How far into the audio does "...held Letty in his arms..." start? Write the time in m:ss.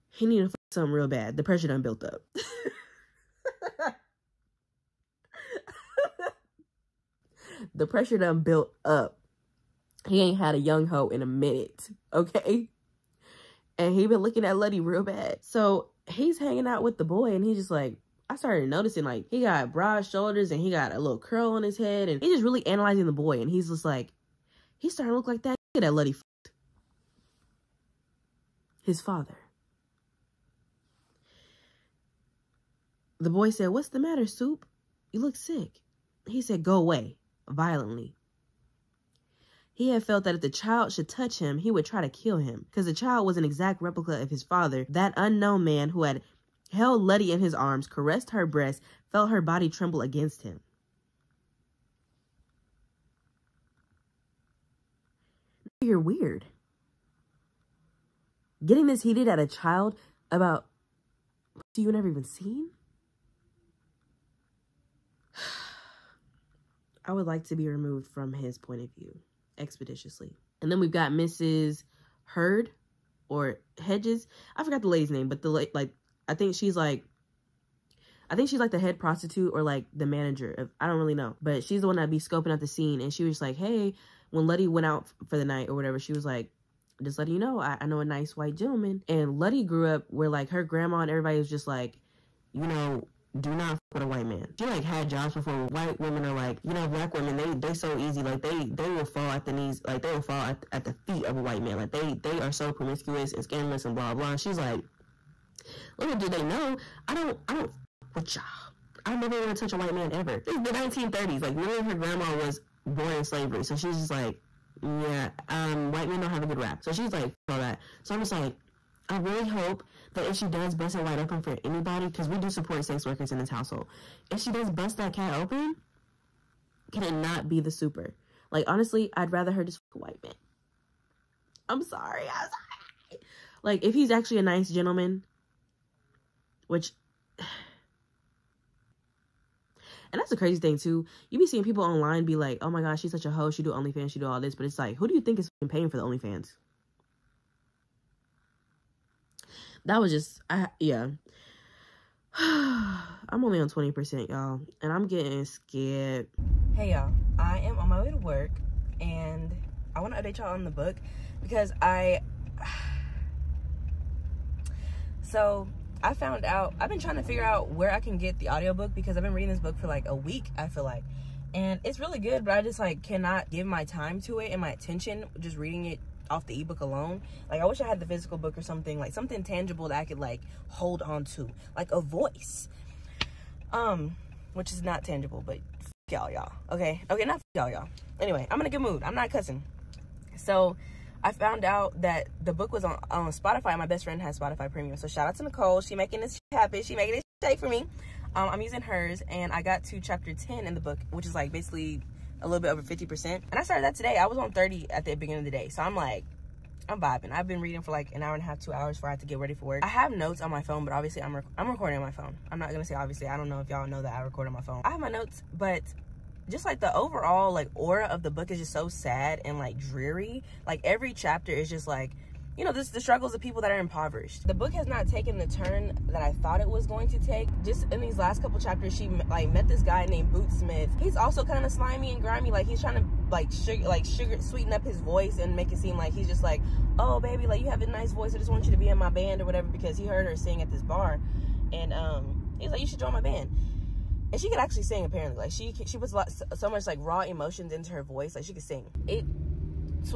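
0:46.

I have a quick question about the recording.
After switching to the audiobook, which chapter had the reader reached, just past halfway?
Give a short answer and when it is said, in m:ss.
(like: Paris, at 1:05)
10, at 3:20.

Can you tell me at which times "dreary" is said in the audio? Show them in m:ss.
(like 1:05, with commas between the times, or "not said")
3:39.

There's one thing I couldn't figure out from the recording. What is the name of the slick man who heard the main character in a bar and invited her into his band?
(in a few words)
Boot Smith.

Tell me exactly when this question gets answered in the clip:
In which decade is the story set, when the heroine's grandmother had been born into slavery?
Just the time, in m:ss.
1:50.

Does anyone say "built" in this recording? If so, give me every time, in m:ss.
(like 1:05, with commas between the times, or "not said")
0:01, 0:08.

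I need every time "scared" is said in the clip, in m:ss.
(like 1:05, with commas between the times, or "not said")
2:35.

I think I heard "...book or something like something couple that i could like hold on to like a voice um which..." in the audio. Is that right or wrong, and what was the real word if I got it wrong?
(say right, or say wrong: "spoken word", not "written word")
wrong: "tangible", not "couple".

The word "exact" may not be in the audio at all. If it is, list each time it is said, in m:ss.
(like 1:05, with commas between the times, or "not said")
0:43.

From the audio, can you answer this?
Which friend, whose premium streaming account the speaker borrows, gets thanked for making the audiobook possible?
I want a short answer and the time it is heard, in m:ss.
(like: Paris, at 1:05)
Nicole, at 3:15.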